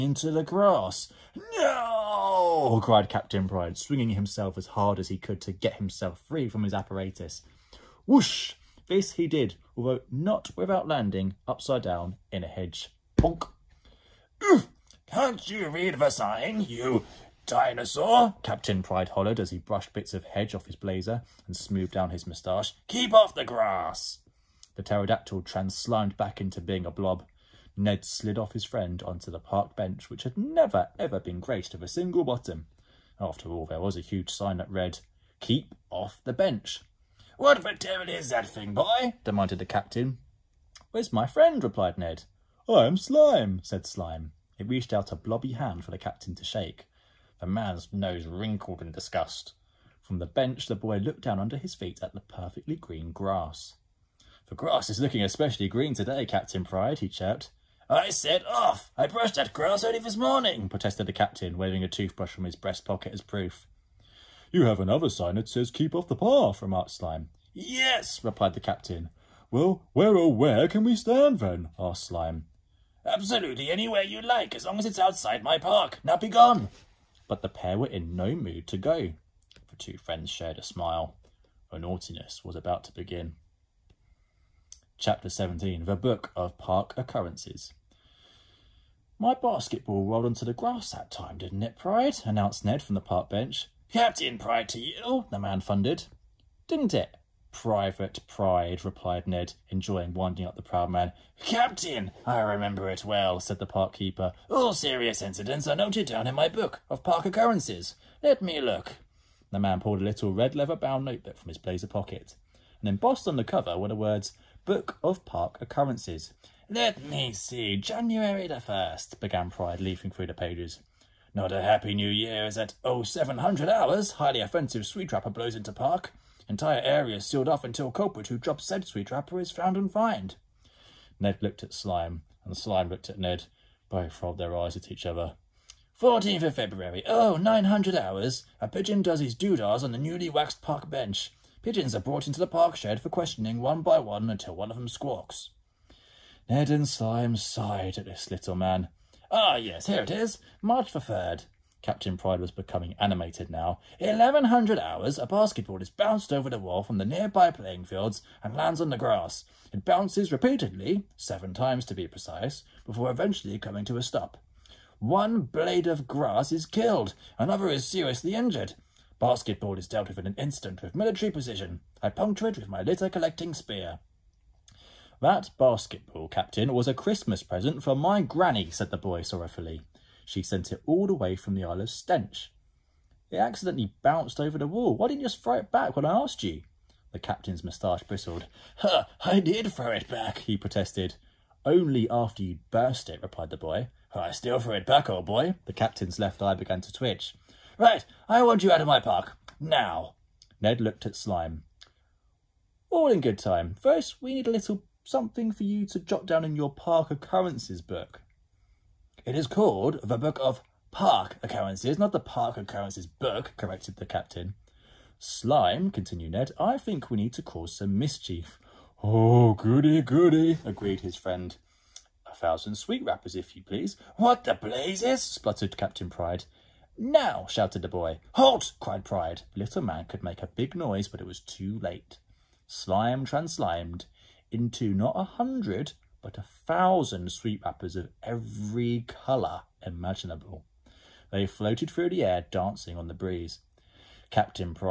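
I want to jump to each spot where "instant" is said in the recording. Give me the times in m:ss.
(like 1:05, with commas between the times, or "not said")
2:50.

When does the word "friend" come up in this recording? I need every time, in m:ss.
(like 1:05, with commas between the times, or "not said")
0:28, 0:41, 1:19, 3:41.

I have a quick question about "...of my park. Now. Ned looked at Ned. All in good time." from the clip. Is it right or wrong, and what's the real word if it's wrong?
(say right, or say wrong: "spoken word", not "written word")
wrong: "Slime", not "Ned".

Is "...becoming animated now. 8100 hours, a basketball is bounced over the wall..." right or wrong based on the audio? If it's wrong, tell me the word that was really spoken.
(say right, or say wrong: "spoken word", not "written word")
wrong: "1100", not "8100".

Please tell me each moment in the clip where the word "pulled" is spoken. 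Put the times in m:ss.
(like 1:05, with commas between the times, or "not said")
1:49.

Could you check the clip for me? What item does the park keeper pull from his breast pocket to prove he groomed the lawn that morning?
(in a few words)
toothbrush.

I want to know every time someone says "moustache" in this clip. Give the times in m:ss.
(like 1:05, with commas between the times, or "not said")
0:22, 3:07.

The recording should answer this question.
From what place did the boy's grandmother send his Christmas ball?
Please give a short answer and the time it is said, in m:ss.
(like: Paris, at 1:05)
Isle of Stench, at 3:01.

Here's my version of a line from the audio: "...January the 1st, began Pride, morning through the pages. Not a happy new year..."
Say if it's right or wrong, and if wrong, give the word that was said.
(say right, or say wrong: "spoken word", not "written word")
wrong: "leafing", not "morning".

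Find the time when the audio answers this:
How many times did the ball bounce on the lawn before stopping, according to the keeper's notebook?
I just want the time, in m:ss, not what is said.
2:41.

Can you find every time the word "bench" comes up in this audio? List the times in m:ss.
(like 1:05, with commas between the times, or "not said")
0:29, 0:36, 0:50, 1:33, 2:20.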